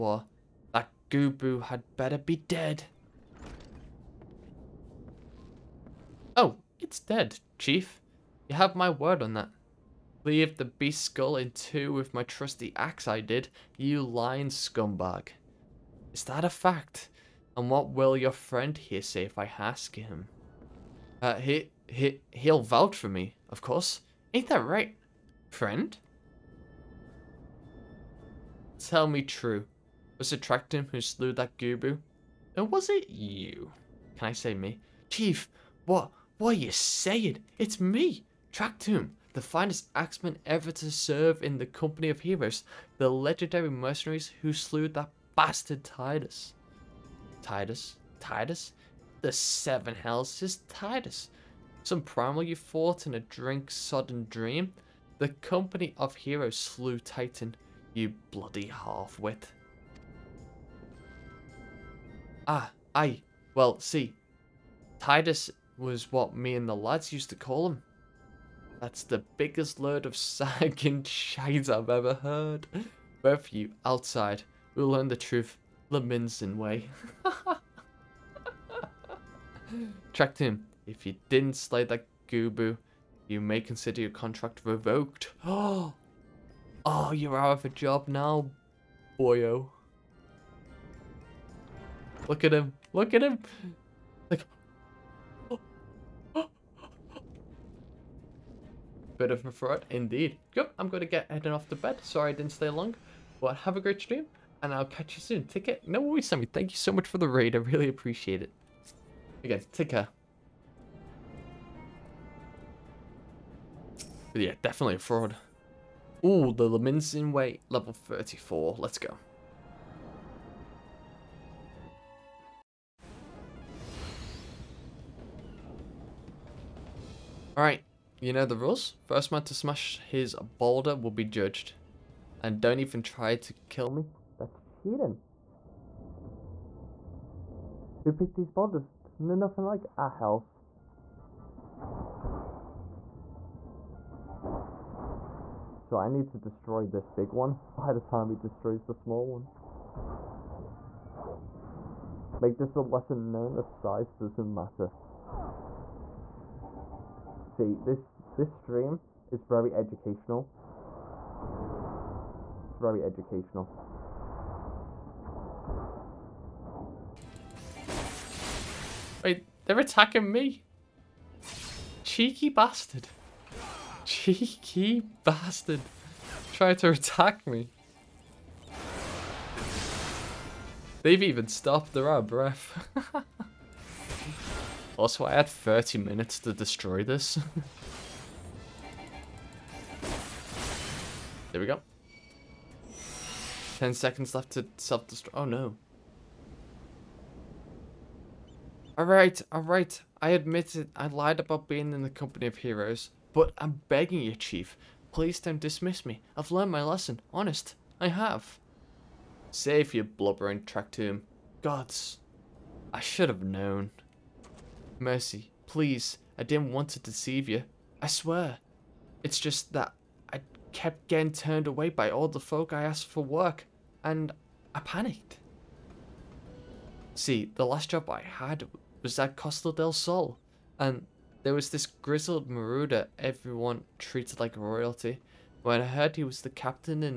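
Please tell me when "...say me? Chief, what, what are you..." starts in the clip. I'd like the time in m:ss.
0:34.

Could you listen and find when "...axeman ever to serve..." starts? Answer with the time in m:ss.
0:39.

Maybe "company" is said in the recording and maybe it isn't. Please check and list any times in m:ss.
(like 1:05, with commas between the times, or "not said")
0:41, 0:55, 3:22.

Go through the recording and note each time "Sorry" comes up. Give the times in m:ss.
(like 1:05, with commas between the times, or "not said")
1:42.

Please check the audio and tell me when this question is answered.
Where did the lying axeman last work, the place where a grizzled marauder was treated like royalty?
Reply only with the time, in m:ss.
3:49.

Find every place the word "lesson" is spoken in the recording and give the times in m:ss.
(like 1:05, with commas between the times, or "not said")
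2:32, 3:26.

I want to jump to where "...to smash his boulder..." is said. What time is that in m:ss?
2:09.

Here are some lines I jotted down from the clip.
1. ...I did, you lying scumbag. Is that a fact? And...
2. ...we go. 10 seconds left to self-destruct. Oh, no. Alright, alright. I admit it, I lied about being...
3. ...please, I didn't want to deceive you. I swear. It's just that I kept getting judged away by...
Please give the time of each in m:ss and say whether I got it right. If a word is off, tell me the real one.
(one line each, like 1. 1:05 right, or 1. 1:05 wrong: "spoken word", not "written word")
1. 0:13 right
2. 3:11 right
3. 3:35 wrong: "turned", not "judged".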